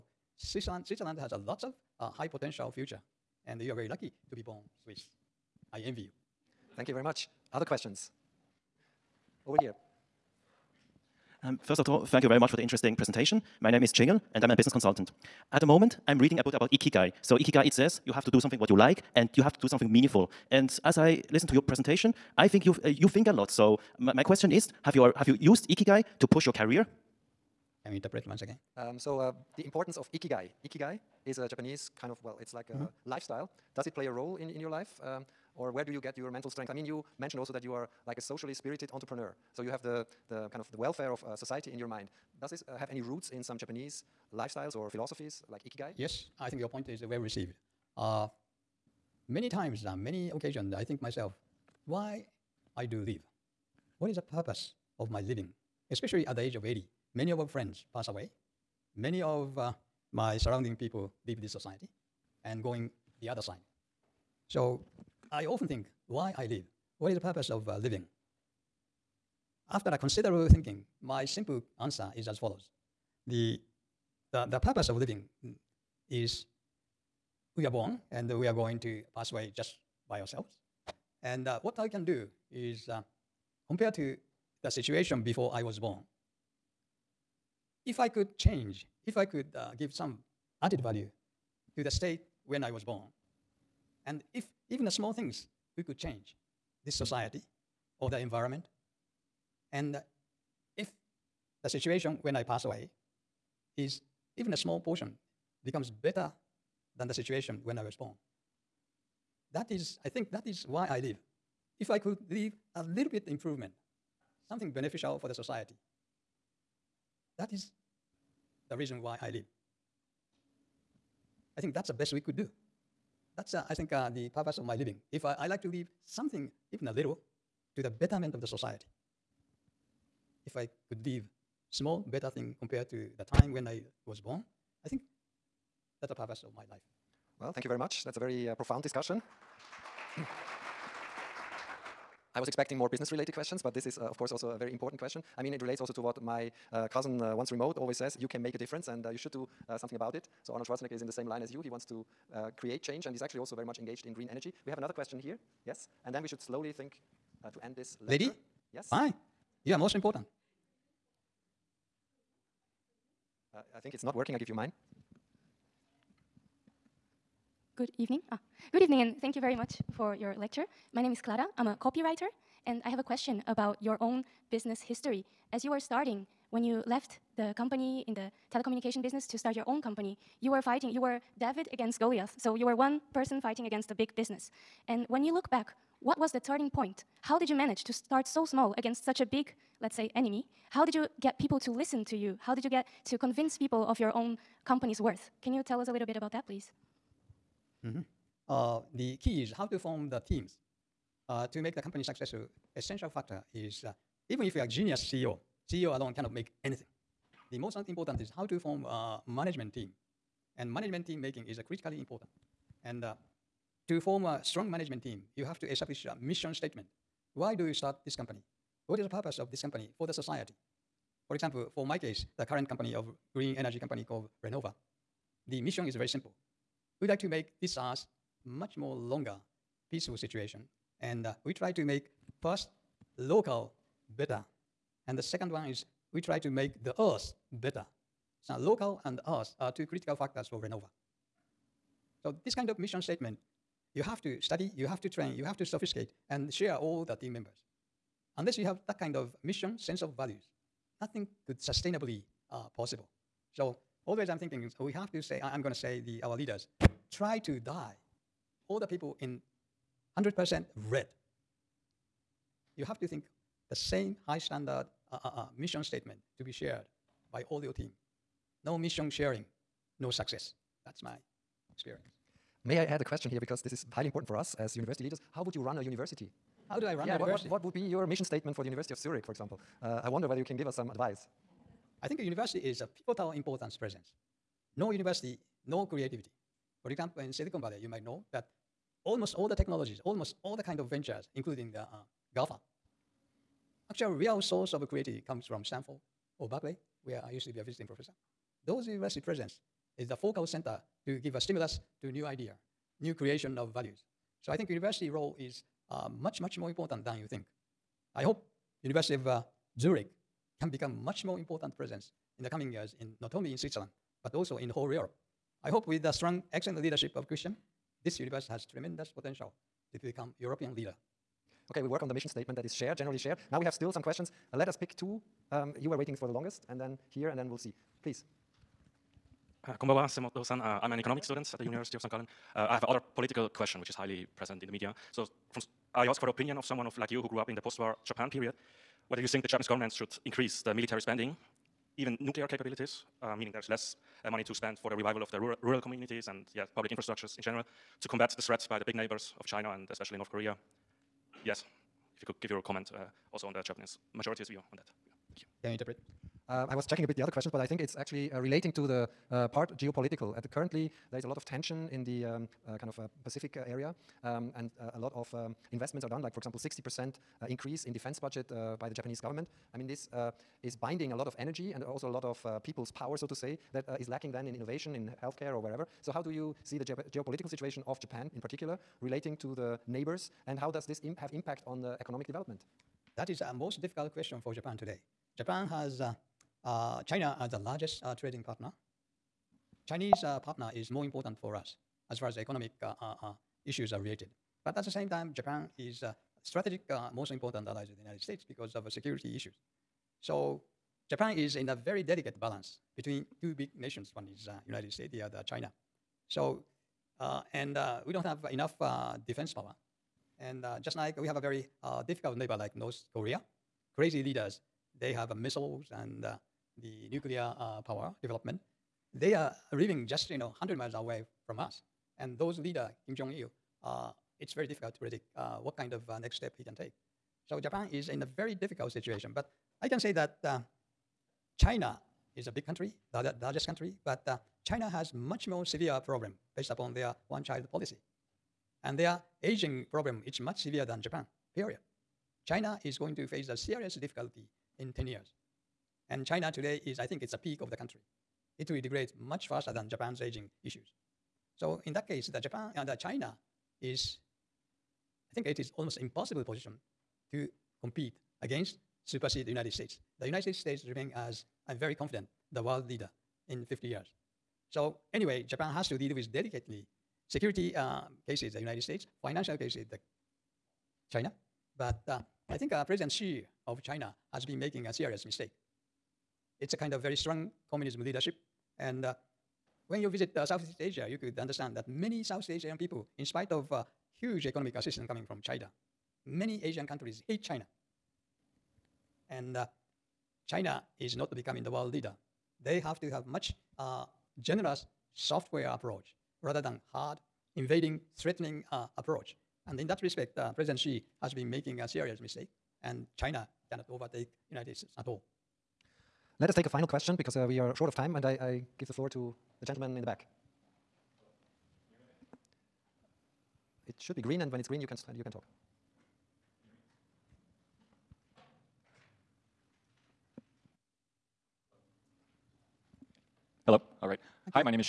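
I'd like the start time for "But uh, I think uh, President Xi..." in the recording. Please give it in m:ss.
7:51.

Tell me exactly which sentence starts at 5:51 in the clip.
Yes, if you could give your comment uh, also on the Japanese majority's view on that.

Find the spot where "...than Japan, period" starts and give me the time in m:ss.
7:20.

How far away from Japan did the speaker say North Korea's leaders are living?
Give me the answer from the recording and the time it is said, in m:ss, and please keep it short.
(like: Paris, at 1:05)
100 miles, at 7:00.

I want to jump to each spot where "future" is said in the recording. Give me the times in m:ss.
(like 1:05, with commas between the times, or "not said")
0:02.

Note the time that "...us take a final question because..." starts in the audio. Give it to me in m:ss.
8:26.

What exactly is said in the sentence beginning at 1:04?
So I often think why I live.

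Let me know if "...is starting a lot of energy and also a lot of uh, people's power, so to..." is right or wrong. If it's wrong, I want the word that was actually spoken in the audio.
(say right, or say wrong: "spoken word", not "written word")
wrong: "binding", not "starting".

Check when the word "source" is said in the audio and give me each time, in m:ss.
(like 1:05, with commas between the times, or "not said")
4:54.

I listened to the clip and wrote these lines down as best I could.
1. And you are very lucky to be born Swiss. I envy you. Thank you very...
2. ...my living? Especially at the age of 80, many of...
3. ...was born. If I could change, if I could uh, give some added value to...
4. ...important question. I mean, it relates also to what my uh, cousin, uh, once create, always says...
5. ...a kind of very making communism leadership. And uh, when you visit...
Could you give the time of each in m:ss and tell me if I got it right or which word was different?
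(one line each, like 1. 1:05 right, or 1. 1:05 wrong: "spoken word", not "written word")
1. 0:03 right
2. 0:55 right
3. 1:25 right
4. 2:24 wrong: "remote", not "create"
5. 7:56 wrong: "strong", not "making".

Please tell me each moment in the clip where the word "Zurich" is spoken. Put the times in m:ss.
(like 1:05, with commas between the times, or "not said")
4:38, 5:09.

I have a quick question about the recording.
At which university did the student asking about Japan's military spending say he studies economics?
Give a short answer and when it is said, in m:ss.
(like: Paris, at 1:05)
University of St. Gallen, at 5:31.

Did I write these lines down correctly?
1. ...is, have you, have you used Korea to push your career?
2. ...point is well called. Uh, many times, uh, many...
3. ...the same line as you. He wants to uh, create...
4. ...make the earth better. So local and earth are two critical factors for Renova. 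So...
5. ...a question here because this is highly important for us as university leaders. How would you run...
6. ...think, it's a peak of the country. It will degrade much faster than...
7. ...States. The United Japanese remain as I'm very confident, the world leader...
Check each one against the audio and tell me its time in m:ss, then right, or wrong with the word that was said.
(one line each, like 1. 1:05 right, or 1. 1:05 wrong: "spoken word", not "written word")
1. 0:24 wrong: "Ikigai", not "Korea"
2. 0:46 wrong: "received", not "called"
3. 2:31 right
4. 3:56 right
5. 4:33 right
6. 7:27 right
7. 7:39 wrong: "States", not "Japanese".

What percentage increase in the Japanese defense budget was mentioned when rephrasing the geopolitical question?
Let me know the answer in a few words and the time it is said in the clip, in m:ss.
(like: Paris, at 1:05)
60 percent, at 6:06.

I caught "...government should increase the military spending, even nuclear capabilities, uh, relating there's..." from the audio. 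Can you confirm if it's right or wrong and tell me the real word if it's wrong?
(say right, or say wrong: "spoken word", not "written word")
wrong: "meaning", not "relating".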